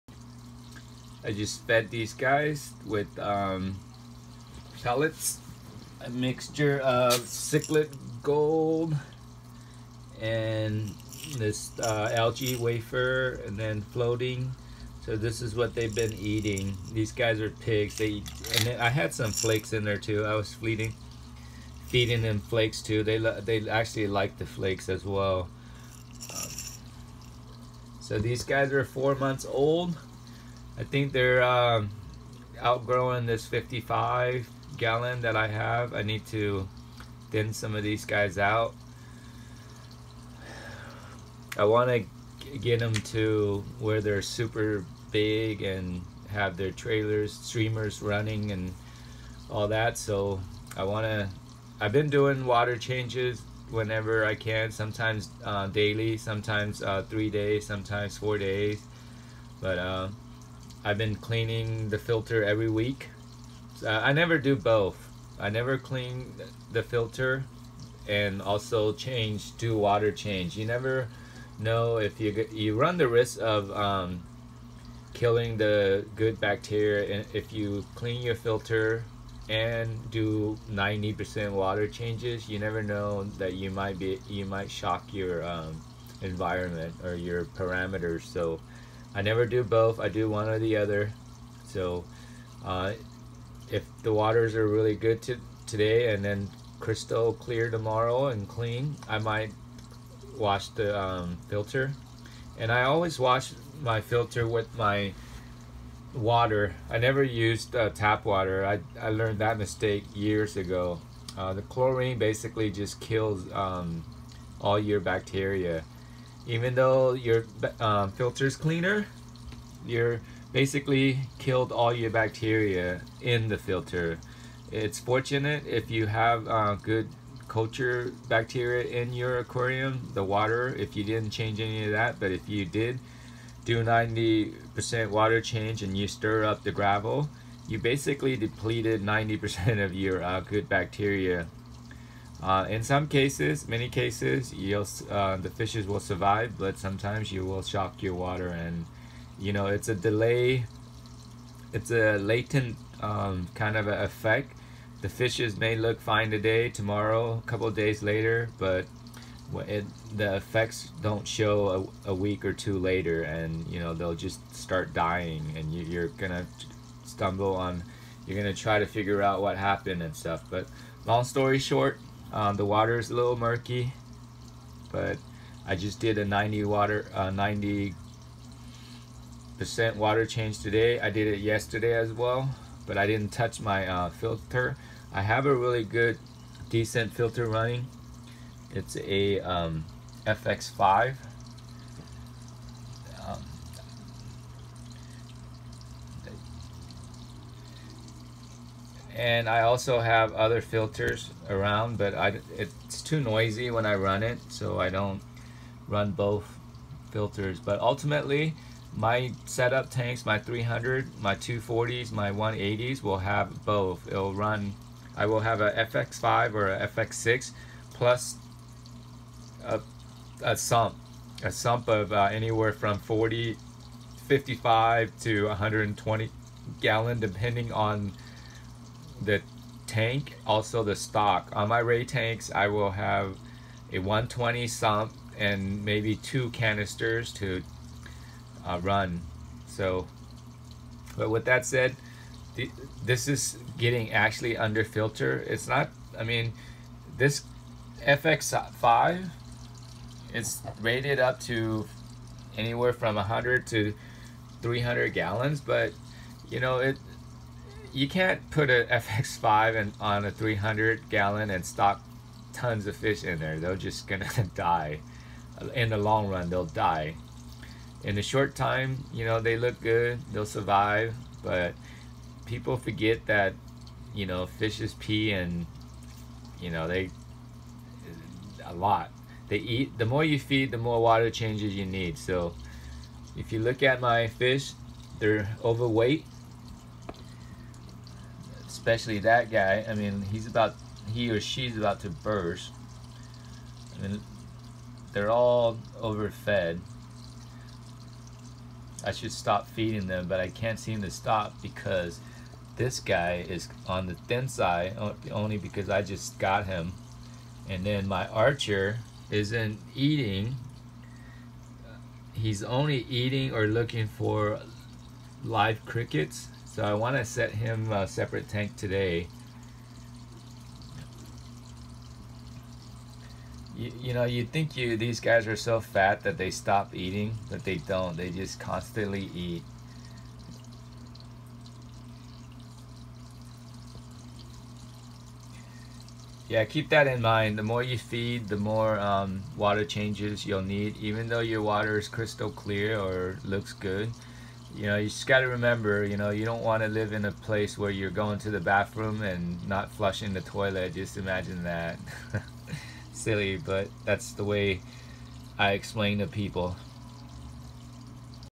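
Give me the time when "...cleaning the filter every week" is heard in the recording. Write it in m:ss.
1:01.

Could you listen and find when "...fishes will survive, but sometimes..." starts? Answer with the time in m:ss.
2:25.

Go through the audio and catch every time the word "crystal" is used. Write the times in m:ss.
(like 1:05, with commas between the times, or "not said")
1:36, 5:42.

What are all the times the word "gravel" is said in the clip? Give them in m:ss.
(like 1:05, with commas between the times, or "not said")
2:16.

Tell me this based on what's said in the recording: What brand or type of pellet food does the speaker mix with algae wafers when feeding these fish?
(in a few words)
cichlid gold.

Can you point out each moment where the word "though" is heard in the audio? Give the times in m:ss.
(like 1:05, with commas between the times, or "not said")
1:56, 5:41.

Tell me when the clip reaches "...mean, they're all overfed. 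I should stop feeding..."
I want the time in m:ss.
4:54.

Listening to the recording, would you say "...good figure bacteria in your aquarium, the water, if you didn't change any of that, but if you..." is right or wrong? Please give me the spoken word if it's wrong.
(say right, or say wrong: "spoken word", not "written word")
wrong: "culture", not "figure".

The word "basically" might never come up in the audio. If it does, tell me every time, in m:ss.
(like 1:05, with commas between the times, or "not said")
1:52, 2:00, 2:17.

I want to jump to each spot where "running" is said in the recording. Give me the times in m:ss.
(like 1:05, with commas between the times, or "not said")
0:48, 3:07.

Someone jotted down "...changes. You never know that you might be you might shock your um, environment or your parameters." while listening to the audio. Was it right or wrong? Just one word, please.
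right.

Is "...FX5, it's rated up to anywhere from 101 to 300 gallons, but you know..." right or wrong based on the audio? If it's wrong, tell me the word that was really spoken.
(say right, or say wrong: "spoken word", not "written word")
wrong: "100", not "101".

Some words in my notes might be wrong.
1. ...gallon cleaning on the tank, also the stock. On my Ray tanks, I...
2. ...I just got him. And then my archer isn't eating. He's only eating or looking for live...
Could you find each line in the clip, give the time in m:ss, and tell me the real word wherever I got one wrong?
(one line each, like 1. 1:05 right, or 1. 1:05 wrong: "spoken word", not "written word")
1. 3:46 wrong: "depending", not "cleaning"
2. 5:05 right.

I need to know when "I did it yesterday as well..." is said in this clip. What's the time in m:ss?
3:00.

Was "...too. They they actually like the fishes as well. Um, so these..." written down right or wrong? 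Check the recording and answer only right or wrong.
wrong.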